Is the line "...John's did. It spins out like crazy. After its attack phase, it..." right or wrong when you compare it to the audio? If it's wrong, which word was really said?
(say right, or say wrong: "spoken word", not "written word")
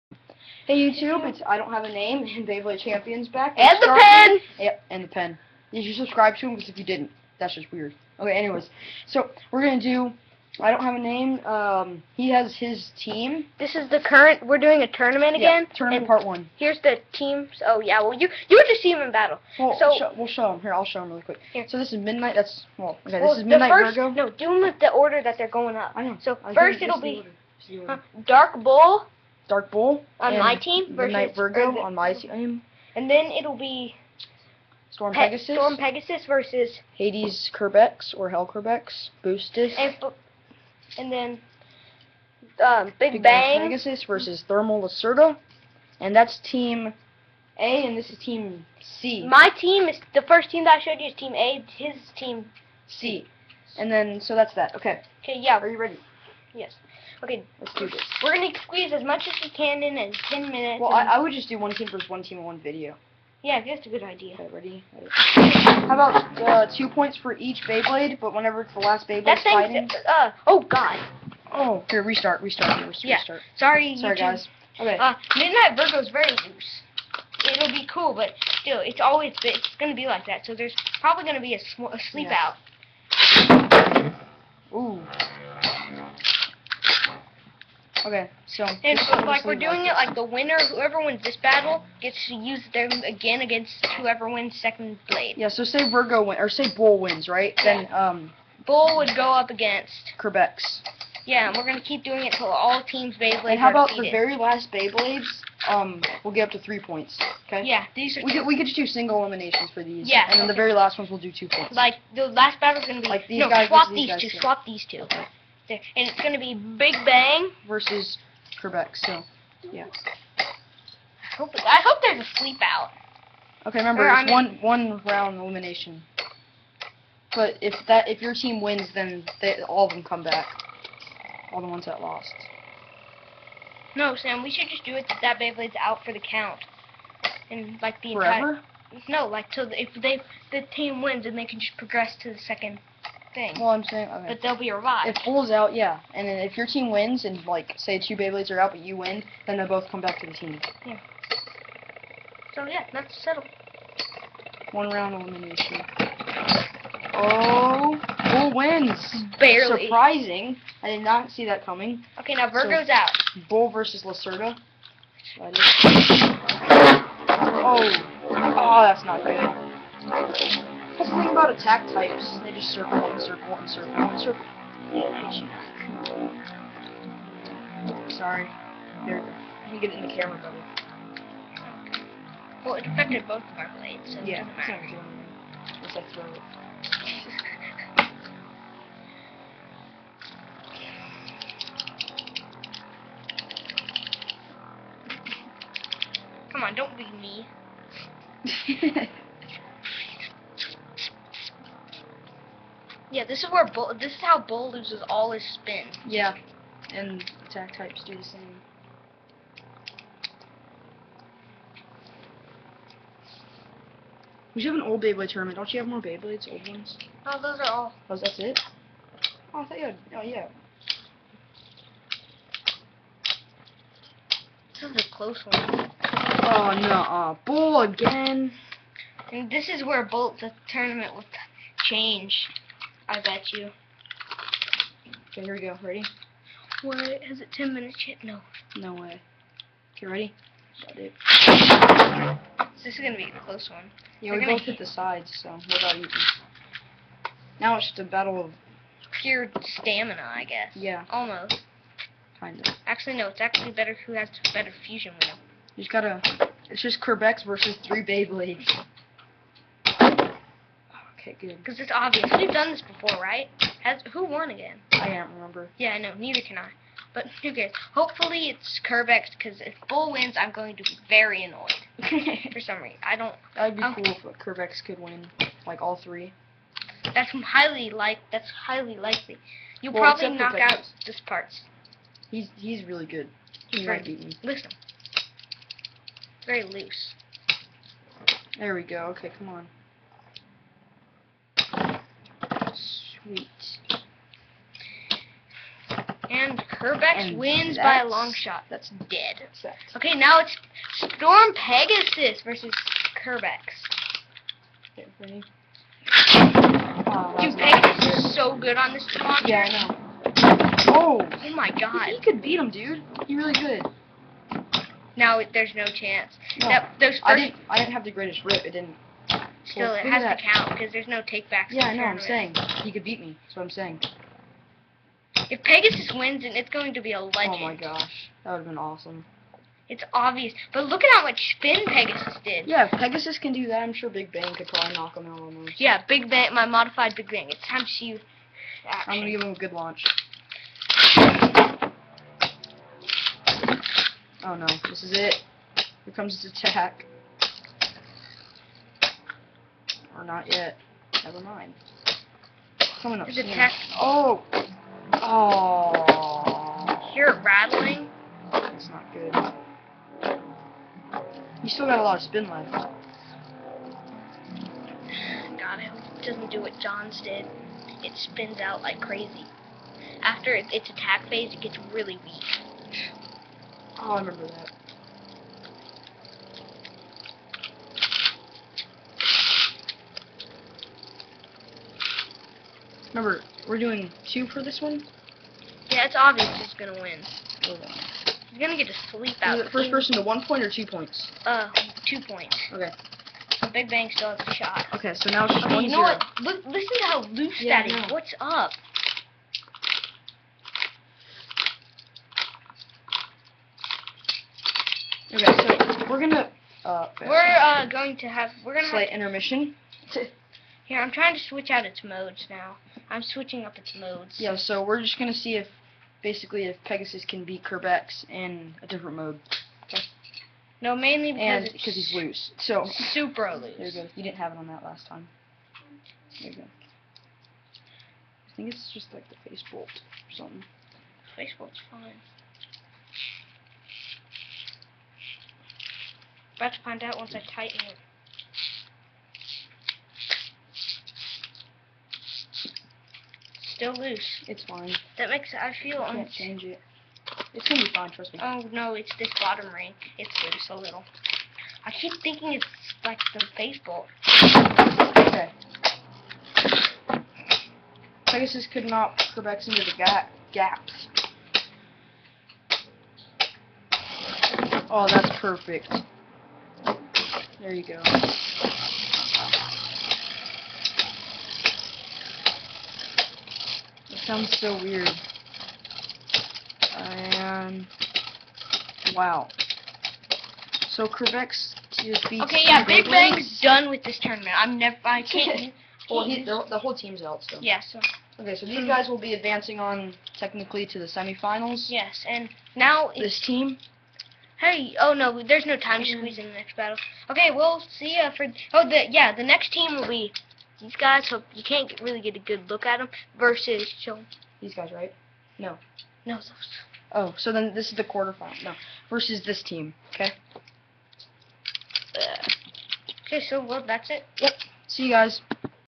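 right.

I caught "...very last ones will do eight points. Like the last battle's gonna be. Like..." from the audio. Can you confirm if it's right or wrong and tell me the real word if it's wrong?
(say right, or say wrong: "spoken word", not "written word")
wrong: "two", not "eight".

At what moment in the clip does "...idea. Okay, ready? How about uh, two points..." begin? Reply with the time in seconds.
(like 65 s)
64 s.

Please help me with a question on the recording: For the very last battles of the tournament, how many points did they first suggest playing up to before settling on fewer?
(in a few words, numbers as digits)
3.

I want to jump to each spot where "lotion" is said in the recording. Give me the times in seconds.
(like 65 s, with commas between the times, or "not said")
not said.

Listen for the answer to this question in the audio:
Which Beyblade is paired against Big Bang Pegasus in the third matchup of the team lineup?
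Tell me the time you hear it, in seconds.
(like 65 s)
44 s.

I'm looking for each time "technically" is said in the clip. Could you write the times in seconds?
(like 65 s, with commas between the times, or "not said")
490 s.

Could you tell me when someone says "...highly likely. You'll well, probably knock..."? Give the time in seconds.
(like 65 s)
278 s.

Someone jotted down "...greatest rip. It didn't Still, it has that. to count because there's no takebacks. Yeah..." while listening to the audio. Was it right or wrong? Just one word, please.
right.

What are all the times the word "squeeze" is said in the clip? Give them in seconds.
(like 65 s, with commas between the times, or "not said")
58 s, 496 s.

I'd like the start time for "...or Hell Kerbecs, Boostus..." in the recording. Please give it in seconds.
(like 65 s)
38 s.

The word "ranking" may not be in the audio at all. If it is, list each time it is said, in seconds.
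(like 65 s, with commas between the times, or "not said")
not said.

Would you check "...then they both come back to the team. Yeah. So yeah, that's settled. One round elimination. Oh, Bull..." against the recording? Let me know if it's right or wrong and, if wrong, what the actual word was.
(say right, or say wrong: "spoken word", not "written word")
right.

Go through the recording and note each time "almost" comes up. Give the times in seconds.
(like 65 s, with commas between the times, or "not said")
251 s, 335 s.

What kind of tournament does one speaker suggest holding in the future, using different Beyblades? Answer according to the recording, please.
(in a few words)
Old Beyblade tournament.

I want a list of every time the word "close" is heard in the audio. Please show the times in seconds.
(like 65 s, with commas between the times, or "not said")
225 s, 243 s.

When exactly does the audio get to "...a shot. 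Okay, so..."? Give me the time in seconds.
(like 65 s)
394 s.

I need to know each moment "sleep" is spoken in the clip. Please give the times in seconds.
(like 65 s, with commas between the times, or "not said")
82 s, 122 s, 389 s.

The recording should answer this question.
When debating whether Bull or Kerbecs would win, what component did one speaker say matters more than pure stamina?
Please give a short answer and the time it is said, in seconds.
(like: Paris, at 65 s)
Fusion wheel, at 254 s.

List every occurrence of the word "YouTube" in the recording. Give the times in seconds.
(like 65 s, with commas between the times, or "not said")
0 s, 74 s.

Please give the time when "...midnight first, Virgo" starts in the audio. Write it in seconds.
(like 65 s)
23 s.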